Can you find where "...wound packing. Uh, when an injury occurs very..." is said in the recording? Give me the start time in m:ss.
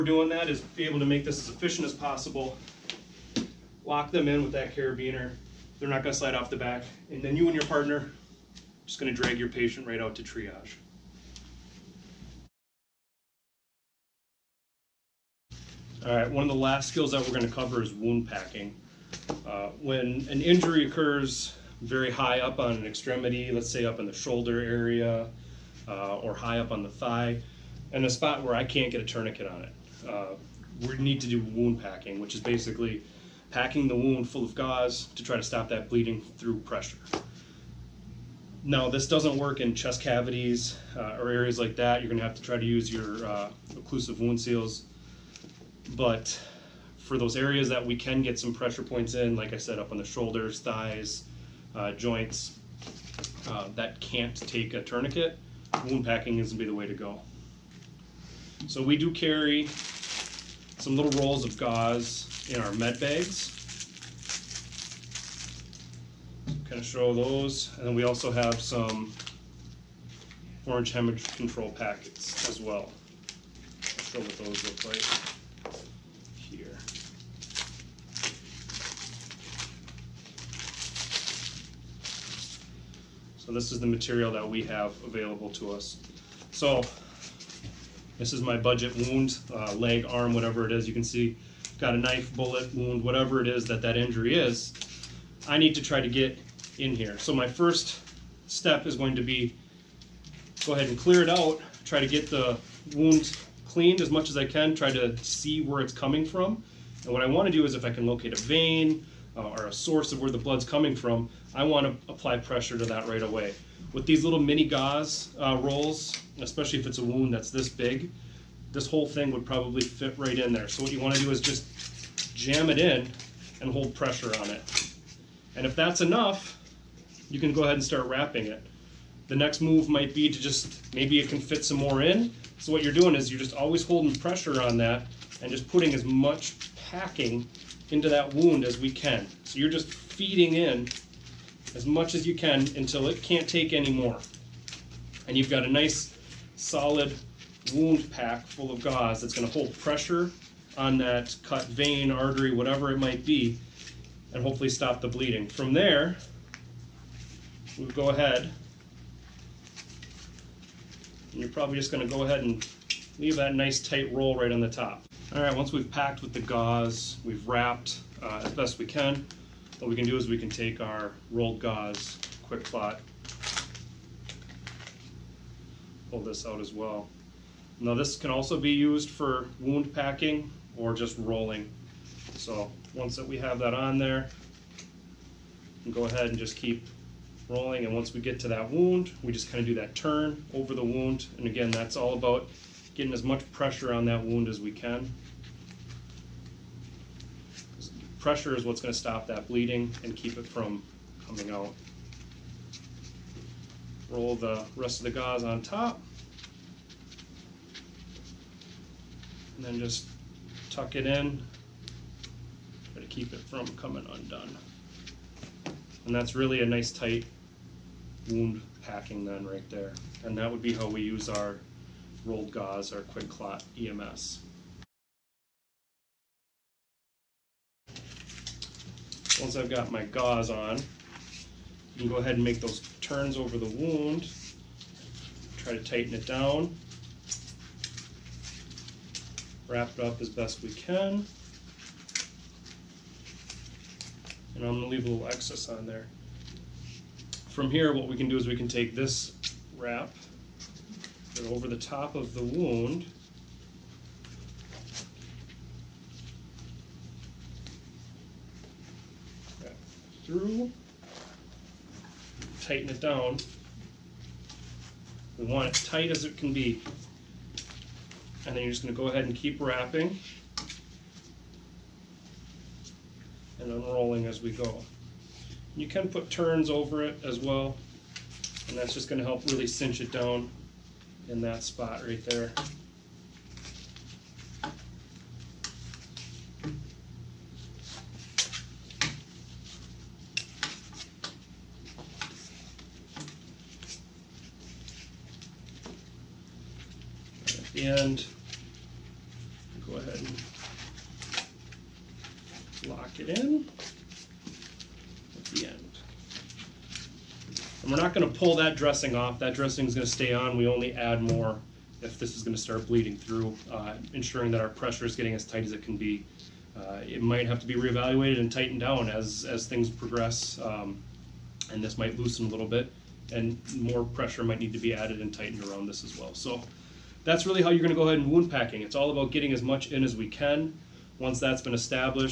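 0:17.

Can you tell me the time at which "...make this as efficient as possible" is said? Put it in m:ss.
0:01.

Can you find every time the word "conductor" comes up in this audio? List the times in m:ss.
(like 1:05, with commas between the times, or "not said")
not said.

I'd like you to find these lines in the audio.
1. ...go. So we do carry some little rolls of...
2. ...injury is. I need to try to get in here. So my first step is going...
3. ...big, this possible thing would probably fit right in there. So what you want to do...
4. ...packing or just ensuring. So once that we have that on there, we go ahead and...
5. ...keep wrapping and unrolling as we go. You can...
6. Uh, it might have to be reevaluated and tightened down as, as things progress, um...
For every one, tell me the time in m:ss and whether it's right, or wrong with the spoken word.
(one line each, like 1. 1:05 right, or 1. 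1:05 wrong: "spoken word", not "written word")
1. 0:56 right
2. 1:33 right
3. 1:57 wrong: "whole", not "possible"
4. 2:59 wrong: "rolling", not "ensuring"
5. 4:29 right
6. 5:16 right.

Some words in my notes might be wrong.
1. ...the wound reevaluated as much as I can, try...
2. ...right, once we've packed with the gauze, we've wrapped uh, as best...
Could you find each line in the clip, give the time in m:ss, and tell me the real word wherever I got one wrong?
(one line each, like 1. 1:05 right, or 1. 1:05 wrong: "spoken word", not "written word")
1. 1:42 wrong: "cleaned", not "reevaluated"
2. 2:45 right.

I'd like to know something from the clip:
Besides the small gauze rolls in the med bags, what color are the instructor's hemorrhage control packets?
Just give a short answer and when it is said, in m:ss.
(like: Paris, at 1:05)
Orange, at 1:10.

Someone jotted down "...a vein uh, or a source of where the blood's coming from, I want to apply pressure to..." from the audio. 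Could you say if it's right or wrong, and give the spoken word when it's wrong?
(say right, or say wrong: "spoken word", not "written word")
right.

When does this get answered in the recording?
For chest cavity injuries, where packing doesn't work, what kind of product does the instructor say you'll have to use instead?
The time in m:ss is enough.
0:43.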